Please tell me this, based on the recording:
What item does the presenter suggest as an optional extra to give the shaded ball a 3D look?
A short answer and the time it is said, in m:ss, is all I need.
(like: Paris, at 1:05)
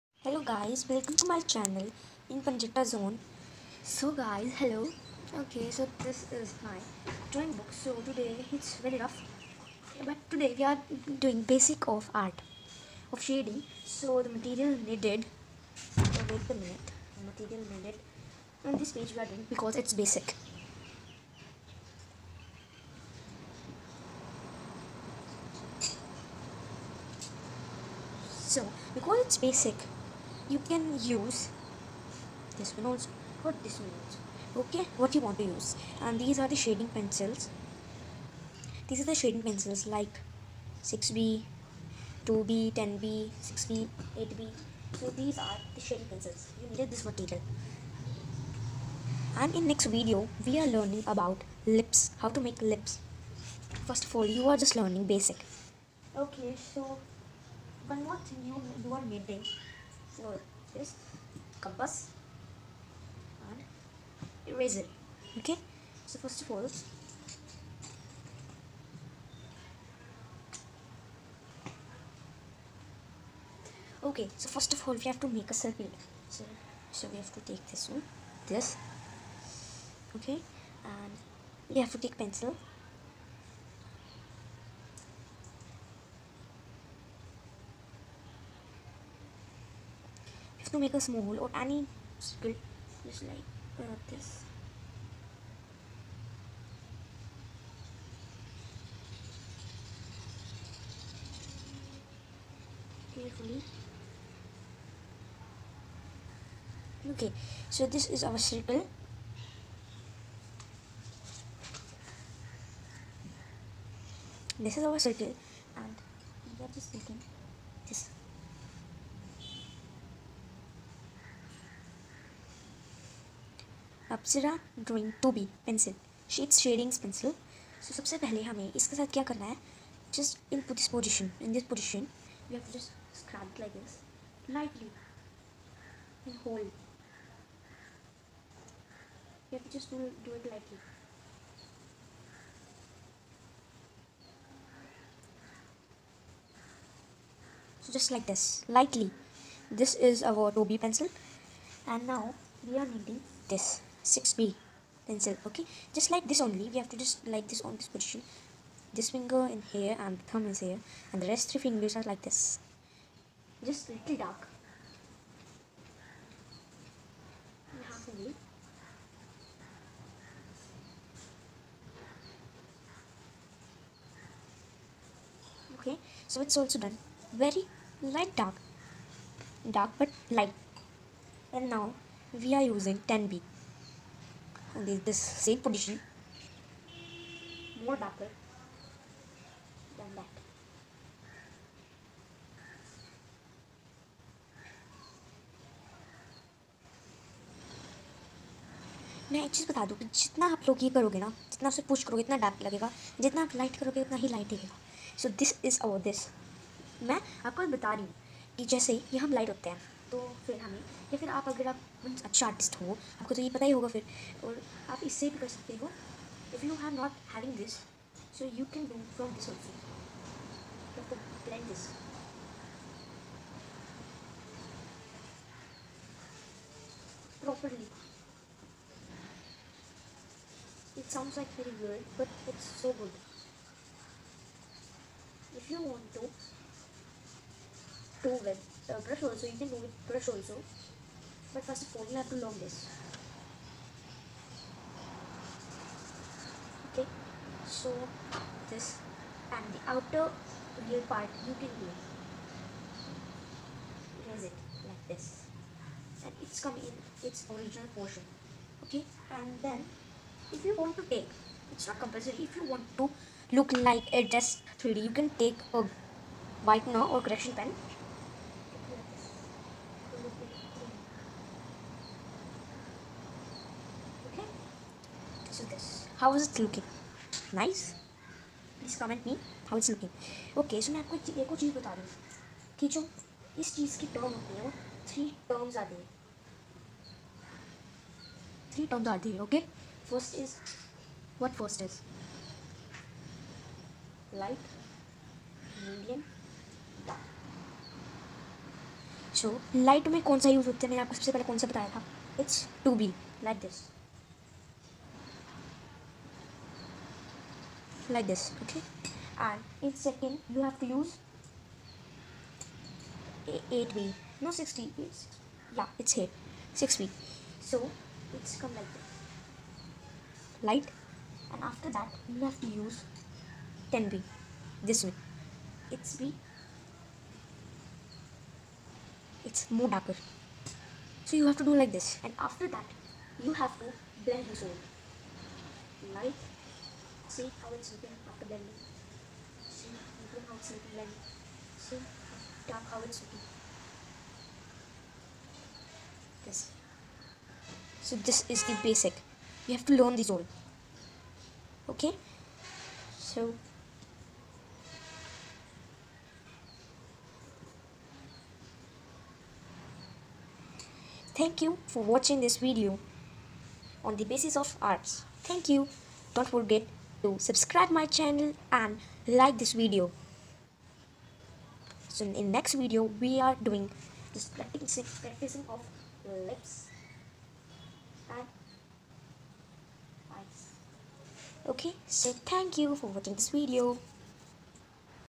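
Whitener or correction pen, at 4:26.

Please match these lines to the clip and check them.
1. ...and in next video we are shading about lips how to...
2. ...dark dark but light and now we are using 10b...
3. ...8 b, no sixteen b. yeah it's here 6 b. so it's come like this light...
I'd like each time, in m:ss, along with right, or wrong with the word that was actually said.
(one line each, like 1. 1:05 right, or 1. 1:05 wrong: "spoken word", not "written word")
1. 0:49 wrong: "learning", not "shading"
2. 2:58 right
3. 5:13 right.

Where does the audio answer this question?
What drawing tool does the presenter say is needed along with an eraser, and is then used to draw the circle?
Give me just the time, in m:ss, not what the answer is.
1:01.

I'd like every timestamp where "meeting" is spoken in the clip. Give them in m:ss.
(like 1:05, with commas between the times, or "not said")
0:59.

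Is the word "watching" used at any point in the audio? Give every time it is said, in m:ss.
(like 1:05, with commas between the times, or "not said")
6:02, 6:23.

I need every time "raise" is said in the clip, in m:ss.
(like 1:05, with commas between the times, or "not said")
4:14.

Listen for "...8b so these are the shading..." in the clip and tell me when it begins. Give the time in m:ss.
0:44.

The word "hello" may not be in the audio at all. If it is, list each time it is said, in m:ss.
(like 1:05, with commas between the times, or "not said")
0:00, 0:04.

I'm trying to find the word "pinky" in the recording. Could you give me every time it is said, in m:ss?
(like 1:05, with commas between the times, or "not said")
not said.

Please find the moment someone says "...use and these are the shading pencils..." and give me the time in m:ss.
0:35.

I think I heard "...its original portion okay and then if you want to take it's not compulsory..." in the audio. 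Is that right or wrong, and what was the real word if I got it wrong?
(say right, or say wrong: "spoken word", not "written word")
right.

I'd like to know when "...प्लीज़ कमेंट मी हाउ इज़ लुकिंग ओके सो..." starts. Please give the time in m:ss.
4:38.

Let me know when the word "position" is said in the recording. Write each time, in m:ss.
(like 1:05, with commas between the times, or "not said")
2:37, 3:05.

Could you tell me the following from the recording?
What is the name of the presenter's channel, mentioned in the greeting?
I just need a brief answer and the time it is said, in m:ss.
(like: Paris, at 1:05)
Panjeta zone, at 0:02.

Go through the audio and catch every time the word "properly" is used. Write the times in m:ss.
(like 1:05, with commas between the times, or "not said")
3:47.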